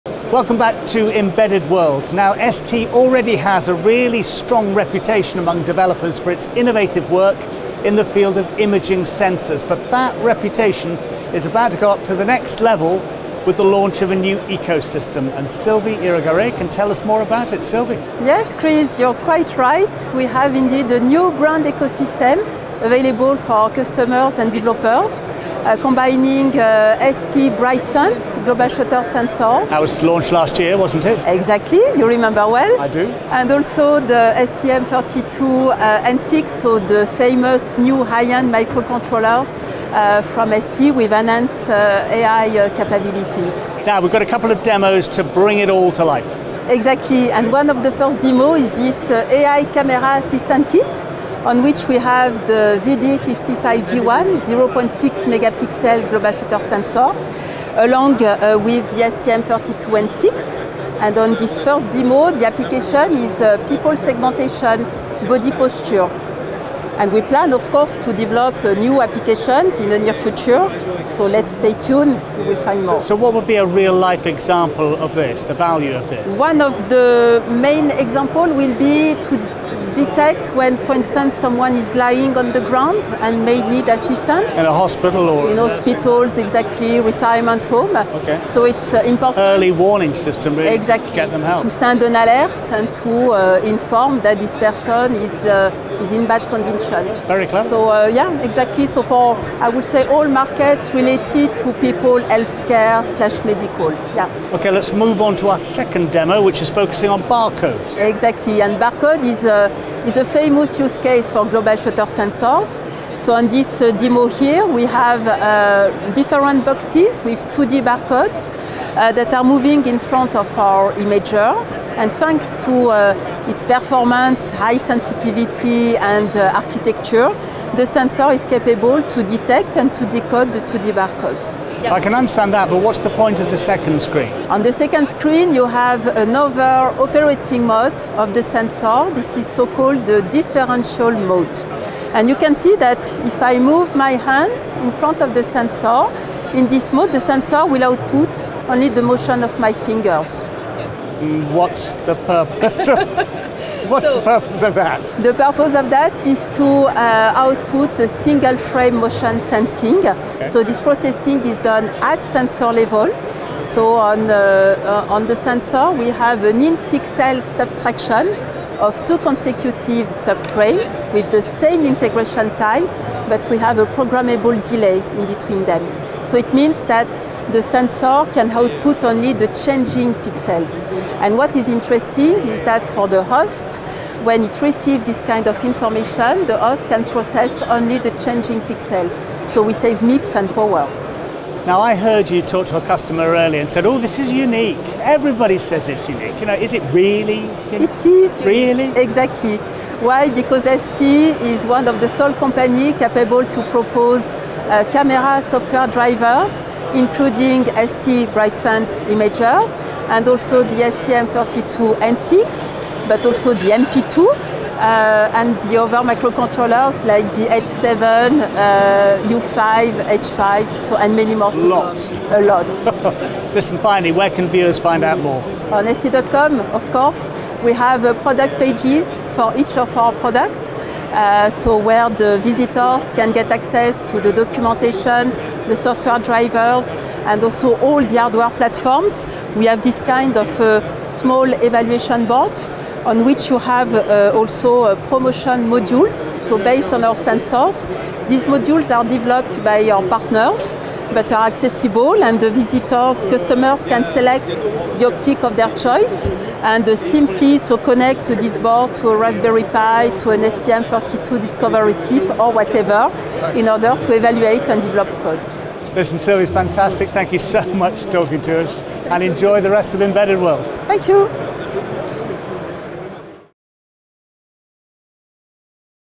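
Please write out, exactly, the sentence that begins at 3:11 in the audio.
Now I heard you talk to a customer earlier and said, "Oh, this is unique.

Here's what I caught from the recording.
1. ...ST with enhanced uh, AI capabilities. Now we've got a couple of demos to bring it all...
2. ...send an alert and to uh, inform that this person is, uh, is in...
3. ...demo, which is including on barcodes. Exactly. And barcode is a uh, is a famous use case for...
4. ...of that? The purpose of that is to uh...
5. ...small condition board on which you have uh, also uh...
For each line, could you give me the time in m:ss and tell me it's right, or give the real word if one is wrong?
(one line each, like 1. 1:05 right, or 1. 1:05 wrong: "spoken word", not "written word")
1. 0:40 right
2. 1:31 right
3. 1:46 wrong: "focusing", not "including"
4. 2:34 right
5. 4:01 wrong: "evaluation", not "condition".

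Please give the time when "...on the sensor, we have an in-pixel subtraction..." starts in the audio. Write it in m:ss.
2:45.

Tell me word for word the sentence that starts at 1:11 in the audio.
So let's stay tuned, we will find more.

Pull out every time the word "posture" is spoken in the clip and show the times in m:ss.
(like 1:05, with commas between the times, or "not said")
1:05.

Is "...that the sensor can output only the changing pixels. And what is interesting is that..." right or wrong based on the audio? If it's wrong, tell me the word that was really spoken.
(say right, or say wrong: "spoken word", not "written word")
right.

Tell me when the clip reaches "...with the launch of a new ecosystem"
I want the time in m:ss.
0:13.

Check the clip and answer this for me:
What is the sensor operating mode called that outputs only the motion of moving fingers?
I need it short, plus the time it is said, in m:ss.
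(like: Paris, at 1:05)
differential mode, at 2:20.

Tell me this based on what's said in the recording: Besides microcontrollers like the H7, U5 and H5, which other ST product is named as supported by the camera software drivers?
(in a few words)
MP2.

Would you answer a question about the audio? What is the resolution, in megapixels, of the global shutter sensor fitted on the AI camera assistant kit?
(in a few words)
0.6 megapixel.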